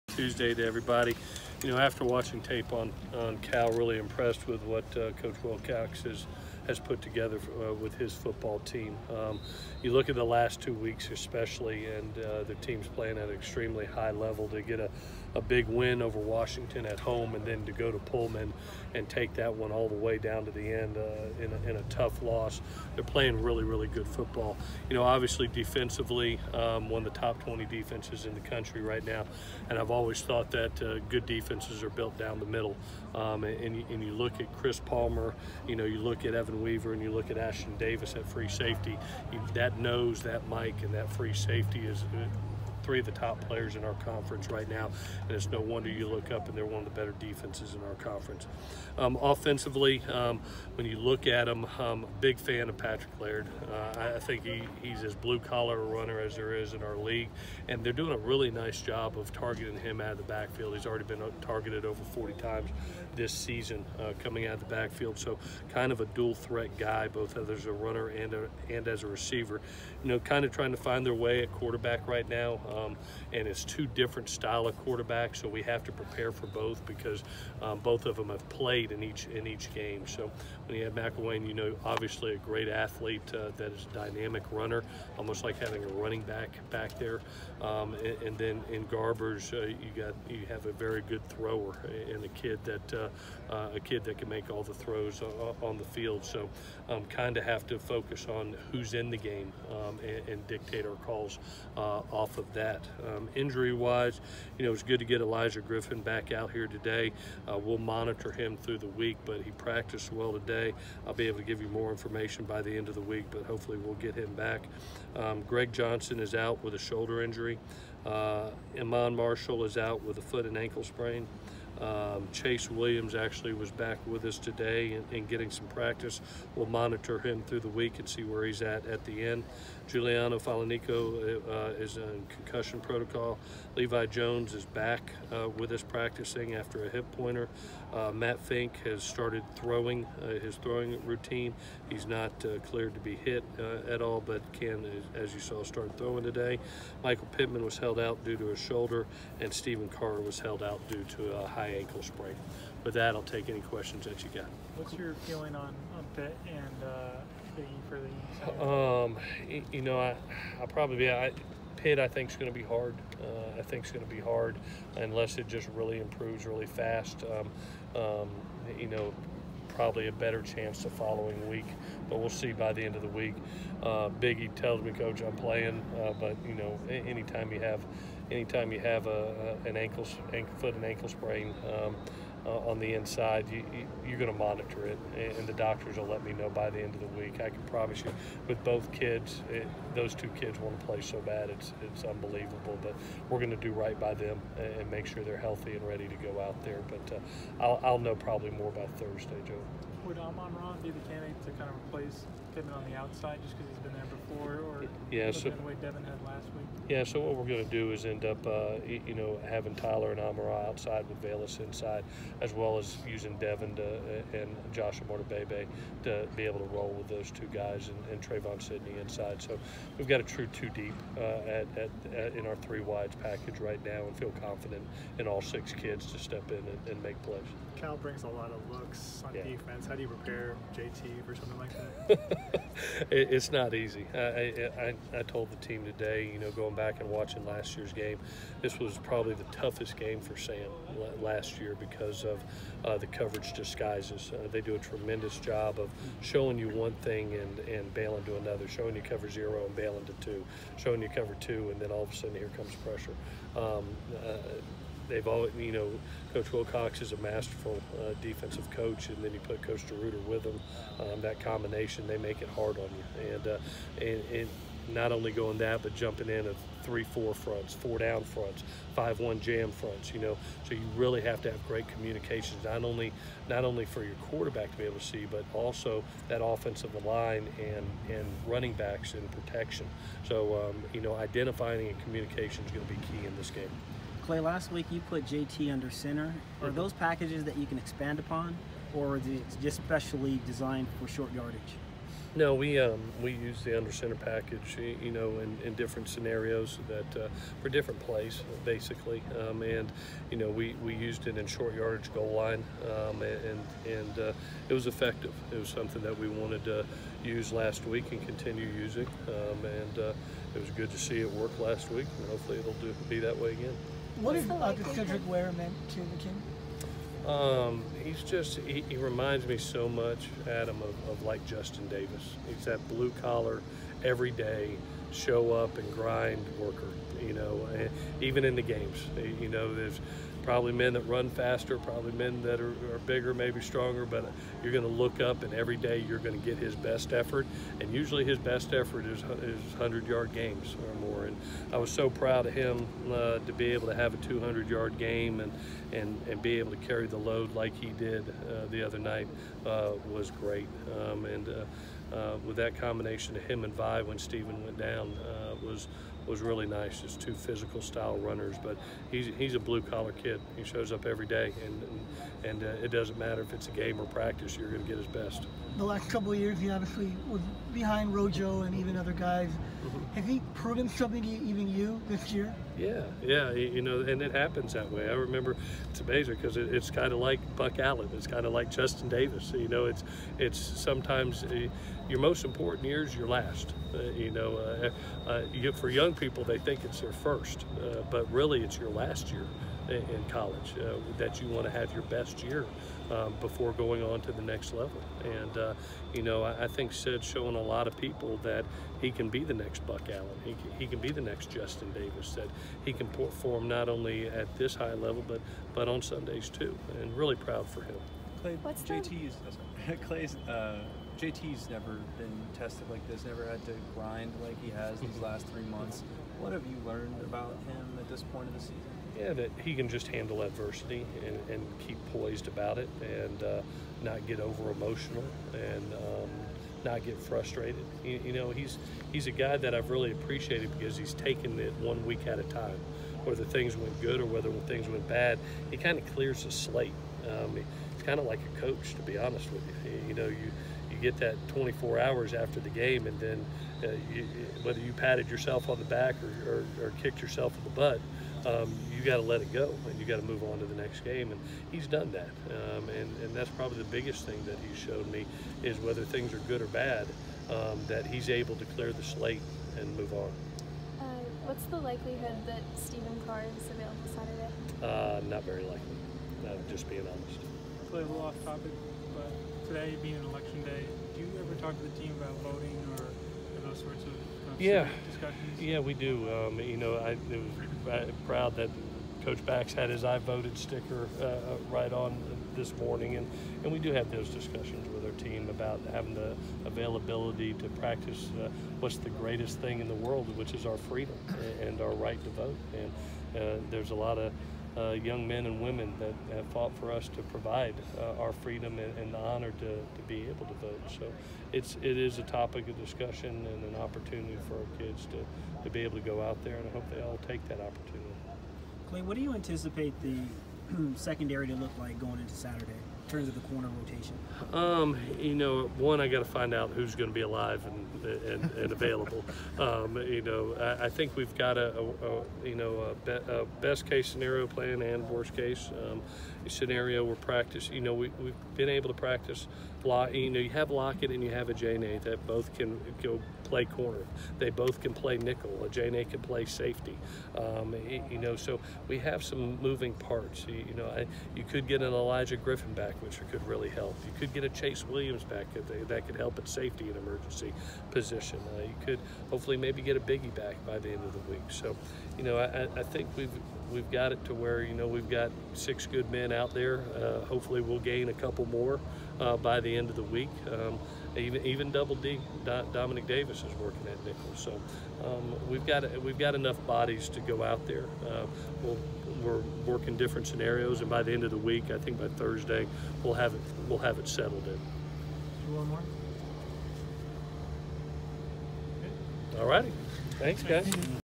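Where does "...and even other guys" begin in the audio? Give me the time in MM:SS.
06:08.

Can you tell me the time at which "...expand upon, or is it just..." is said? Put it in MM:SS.
04:47.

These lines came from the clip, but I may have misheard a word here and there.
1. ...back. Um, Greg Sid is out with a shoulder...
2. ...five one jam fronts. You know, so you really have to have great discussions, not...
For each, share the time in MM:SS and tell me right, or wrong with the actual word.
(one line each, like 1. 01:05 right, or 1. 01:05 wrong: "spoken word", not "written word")
1. 01:54 wrong: "Johnson", not "Sid"
2. 04:28 wrong: "communications", not "discussions".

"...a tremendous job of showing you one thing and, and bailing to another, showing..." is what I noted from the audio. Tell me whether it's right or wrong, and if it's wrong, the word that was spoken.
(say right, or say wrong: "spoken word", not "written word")
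right.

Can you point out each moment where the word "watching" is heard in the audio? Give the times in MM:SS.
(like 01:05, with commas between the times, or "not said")
00:02, 03:57.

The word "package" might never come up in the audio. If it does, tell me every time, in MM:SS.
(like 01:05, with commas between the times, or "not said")
03:43, 04:46, 04:54.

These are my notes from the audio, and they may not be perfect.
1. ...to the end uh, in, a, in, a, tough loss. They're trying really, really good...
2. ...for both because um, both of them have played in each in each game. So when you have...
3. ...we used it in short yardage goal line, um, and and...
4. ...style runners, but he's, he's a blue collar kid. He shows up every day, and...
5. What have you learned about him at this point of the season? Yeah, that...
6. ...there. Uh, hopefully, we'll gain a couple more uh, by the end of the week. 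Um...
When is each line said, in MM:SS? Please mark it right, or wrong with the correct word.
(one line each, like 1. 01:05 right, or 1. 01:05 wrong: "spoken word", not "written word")
1. 00:20 wrong: "playing", not "trying"
2. 01:16 right
3. 05:00 right
4. 05:57 right
5. 06:56 right
6. 09:16 right.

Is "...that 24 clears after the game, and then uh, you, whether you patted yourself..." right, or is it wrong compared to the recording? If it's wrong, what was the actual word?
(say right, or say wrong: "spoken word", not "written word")
wrong: "hours", not "clears".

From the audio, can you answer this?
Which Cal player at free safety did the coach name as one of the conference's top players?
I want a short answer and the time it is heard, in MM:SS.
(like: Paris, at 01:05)
Ashtyn Davis, at 00:37.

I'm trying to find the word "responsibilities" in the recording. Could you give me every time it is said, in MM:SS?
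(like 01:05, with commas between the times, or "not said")
not said.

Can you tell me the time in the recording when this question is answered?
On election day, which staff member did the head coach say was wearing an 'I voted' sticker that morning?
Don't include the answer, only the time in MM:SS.
07:59.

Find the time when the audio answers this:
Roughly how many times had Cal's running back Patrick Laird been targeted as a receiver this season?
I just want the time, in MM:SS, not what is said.
01:02.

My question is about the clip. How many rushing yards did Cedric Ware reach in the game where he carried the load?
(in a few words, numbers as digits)
200.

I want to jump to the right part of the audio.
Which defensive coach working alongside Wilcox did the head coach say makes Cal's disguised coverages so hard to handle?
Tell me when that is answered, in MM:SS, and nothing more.
04:19.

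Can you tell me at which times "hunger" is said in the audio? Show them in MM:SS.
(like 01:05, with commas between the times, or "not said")
not said.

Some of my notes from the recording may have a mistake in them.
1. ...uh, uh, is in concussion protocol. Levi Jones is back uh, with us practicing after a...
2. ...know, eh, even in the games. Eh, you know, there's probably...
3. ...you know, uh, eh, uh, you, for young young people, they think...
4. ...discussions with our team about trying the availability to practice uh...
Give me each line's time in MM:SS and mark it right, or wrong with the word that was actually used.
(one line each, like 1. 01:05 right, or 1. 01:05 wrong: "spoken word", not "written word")
1. 02:11 right
2. 05:27 right
3. 06:24 right
4. 08:04 wrong: "having", not "trying".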